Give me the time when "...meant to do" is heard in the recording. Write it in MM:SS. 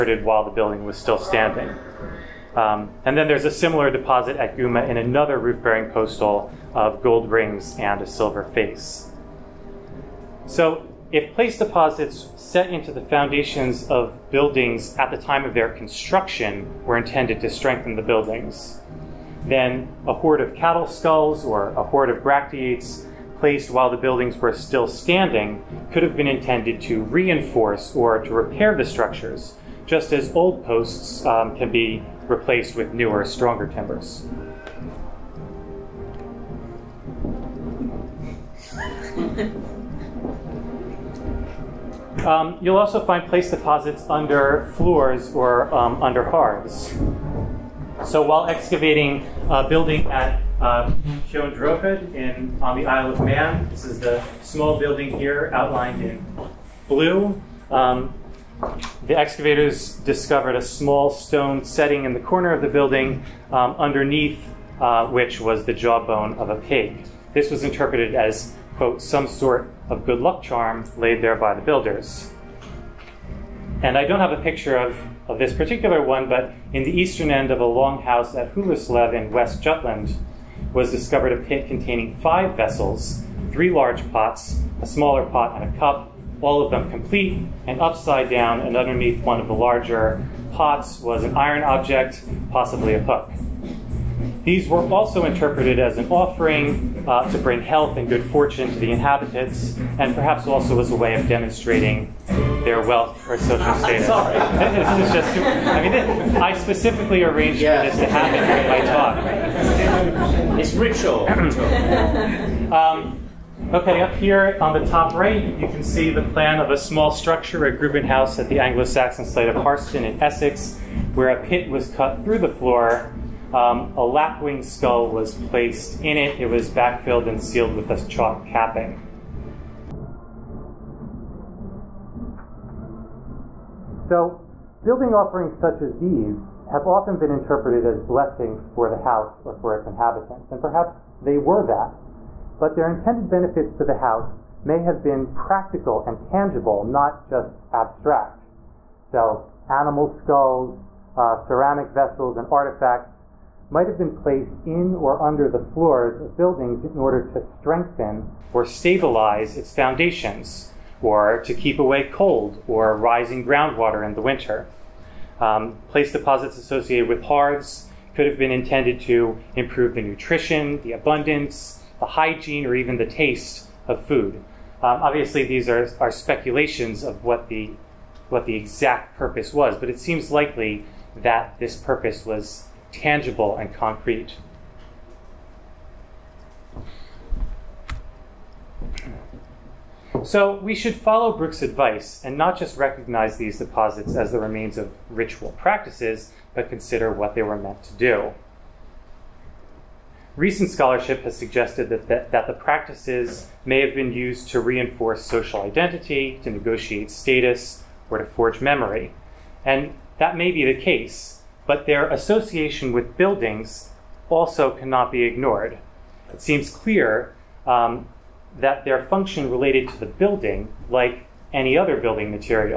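03:17.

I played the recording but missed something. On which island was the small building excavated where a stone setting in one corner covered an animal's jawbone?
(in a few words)
Isle of Man.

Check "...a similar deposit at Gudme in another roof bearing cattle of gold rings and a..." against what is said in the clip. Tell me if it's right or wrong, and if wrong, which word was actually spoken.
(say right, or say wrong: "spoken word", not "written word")
wrong: "posthole", not "cattle".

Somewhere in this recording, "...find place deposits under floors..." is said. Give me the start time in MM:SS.
00:43.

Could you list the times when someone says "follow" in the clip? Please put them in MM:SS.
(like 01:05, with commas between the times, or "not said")
03:10.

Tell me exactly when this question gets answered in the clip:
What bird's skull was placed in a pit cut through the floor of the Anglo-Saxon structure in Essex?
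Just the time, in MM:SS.
02:04.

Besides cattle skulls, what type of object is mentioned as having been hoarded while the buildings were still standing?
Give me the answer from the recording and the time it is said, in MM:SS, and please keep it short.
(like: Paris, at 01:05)
bracteates, at 00:22.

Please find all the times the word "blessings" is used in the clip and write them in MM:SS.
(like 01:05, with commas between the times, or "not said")
02:18.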